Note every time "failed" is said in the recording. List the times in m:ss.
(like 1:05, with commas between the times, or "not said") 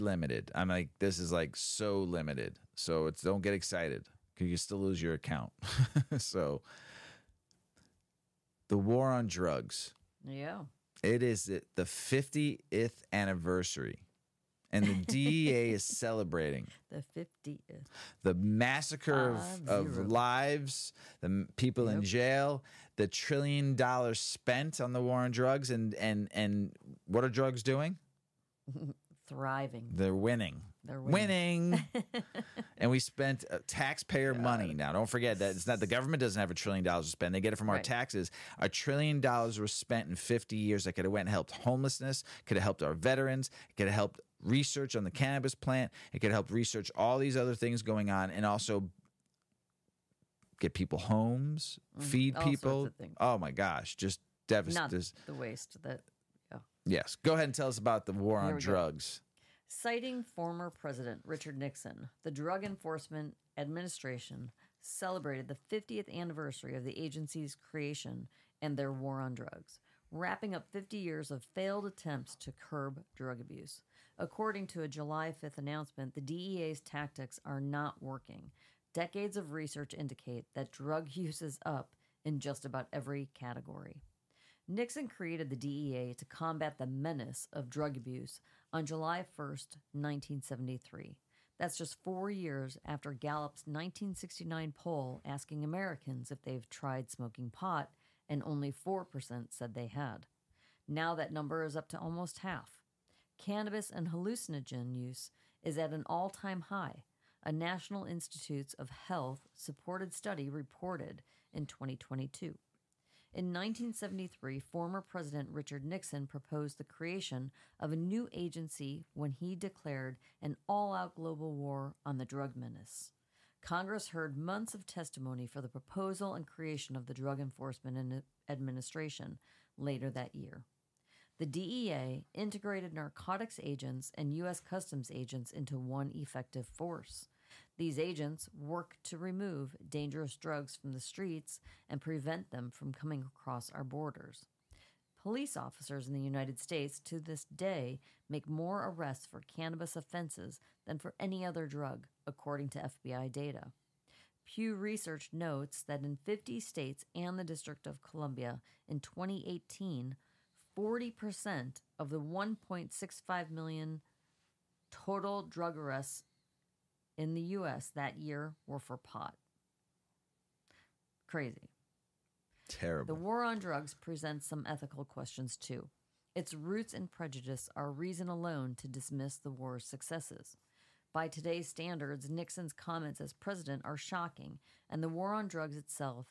1:11.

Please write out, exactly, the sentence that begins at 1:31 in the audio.
That's just four years after Gallup's 1969 poll asking Americans if they've tried smoking pot, and only 4% said they had.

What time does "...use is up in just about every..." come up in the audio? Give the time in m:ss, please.
1:21.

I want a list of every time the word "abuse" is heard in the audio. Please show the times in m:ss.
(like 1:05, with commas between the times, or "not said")
1:13, 1:27.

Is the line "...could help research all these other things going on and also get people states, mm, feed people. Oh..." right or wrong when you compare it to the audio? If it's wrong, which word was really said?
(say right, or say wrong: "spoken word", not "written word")
wrong: "homes", not "states".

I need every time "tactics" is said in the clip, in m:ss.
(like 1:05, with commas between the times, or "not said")
1:16.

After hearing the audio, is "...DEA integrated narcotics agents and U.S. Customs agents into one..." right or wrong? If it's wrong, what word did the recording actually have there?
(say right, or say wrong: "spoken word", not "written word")
right.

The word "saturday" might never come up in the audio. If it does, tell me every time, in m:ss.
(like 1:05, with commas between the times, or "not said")
not said.